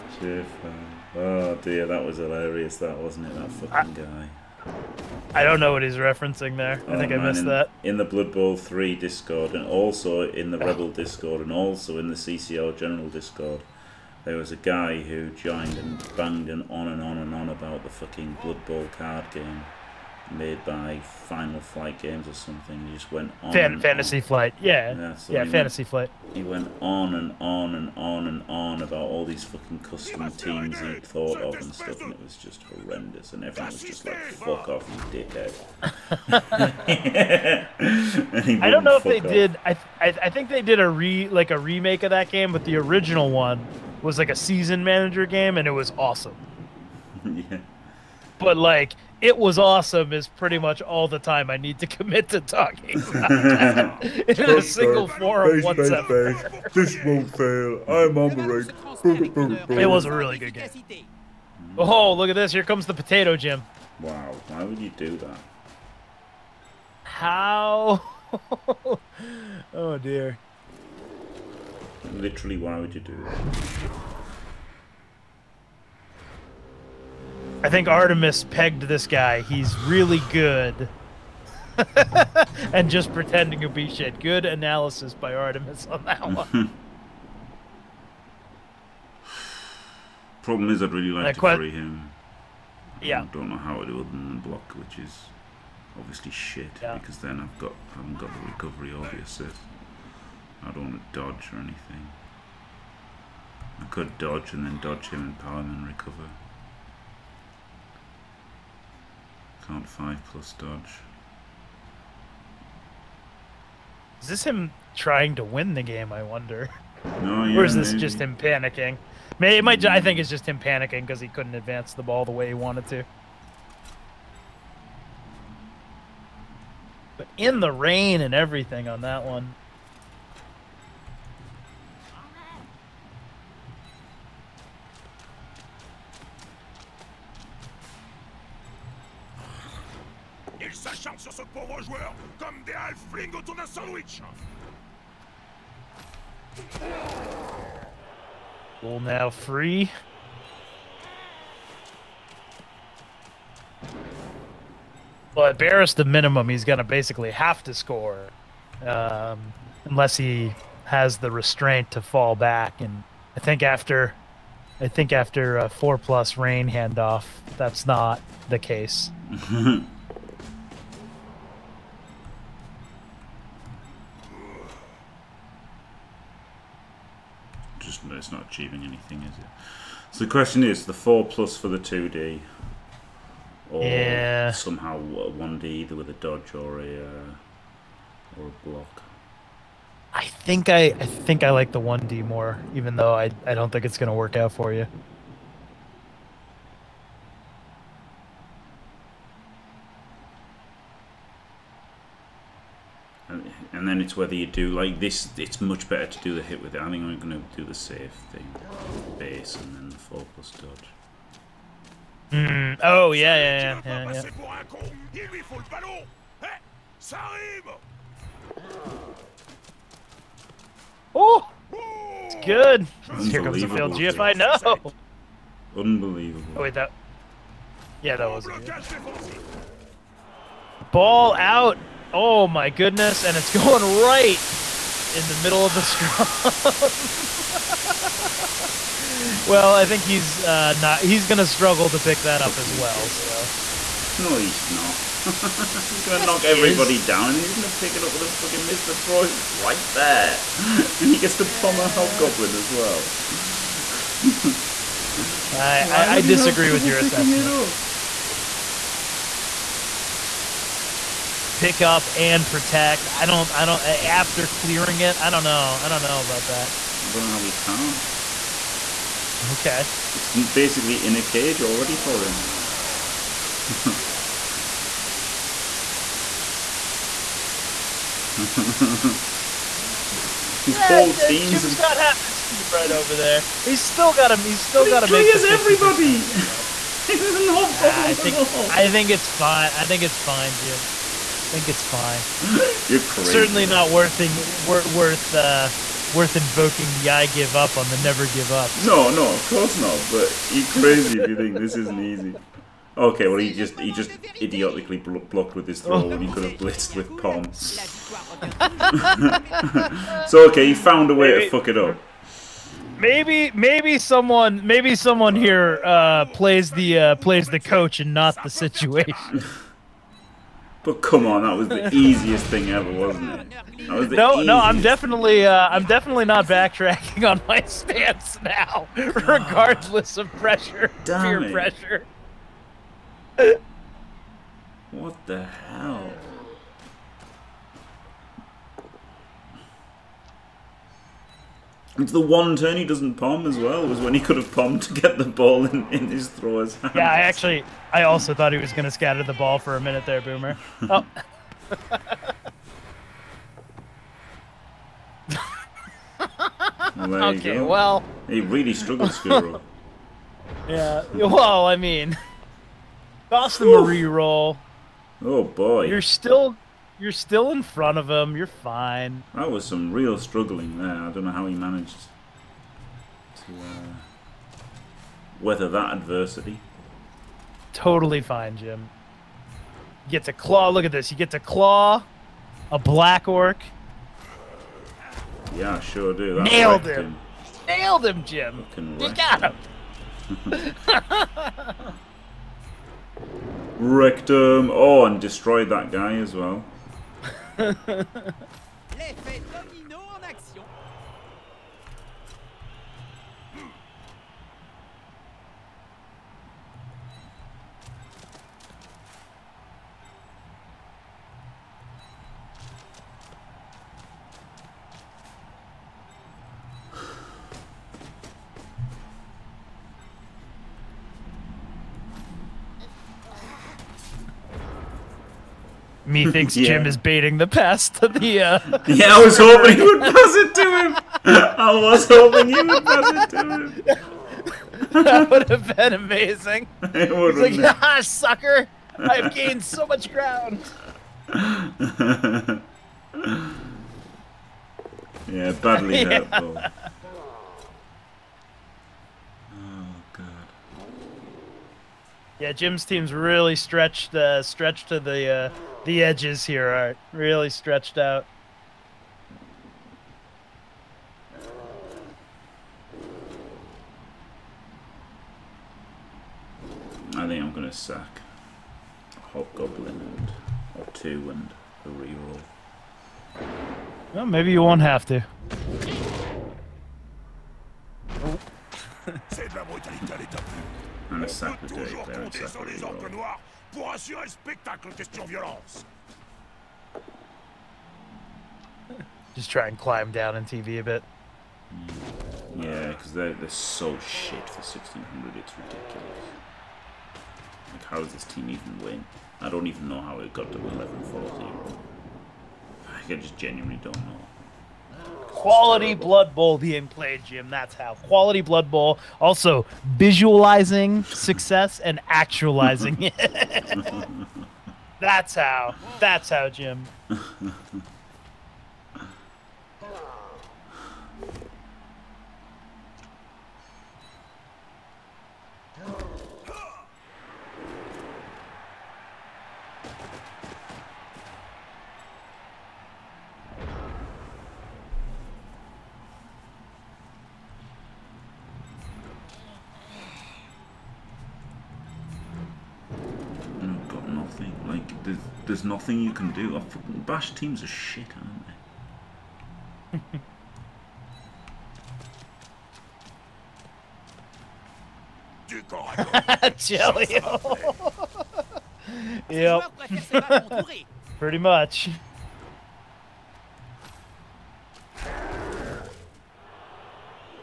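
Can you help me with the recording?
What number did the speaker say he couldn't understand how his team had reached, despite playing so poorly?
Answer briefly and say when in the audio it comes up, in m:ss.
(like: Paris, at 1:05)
1140, at 8:20.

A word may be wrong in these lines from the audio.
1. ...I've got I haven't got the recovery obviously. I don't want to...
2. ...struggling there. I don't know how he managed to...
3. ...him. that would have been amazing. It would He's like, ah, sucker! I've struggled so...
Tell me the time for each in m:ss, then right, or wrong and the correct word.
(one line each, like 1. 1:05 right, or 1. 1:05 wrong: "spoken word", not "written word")
1. 1:37 right
2. 6:10 right
3. 7:13 wrong: "gained", not "struggled".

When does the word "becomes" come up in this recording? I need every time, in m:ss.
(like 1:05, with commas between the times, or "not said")
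not said.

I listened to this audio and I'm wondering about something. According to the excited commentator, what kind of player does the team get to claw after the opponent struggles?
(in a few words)
Black orc.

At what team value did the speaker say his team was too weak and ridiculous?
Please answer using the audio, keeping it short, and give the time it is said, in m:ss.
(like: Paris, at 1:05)
1600, at 8:14.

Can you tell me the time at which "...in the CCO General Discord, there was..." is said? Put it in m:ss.
0:11.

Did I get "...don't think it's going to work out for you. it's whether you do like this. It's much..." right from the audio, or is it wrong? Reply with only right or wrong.
right.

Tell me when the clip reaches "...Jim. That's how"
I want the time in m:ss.
8:27.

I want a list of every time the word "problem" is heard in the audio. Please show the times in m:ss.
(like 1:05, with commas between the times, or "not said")
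1:30, 4:47.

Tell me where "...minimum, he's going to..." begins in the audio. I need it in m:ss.
2:36.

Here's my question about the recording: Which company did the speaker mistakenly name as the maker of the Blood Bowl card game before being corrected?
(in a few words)
Final Flight Games.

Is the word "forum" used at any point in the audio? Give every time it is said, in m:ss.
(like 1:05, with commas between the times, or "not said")
0:55.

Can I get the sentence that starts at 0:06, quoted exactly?
Oh, I think man, I missed in, that.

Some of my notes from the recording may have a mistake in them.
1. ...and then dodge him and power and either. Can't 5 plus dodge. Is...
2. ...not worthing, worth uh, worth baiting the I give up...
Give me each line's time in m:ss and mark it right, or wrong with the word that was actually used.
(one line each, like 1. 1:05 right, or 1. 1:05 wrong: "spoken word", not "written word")
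1. 1:44 wrong: "recover", not "either"
2. 4:53 wrong: "invoking", not "baiting".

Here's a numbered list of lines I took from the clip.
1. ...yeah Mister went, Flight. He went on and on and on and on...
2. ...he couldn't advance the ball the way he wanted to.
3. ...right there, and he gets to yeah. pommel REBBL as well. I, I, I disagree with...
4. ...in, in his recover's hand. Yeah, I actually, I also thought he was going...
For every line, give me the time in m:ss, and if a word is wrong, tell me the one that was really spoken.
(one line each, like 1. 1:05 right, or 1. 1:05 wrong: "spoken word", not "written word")
1. 0:25 wrong: "Fantasy", not "Mister"
2. 2:01 right
3. 4:09 wrong: "Hobgoblin", not "REBBL"
4. 5:45 wrong: "thrower", not "recover".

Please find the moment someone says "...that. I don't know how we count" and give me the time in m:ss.
4:26.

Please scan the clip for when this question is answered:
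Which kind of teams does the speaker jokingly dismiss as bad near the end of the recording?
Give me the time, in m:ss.
9:07.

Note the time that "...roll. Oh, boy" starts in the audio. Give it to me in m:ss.
6:04.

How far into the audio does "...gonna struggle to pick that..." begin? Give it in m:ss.
4:01.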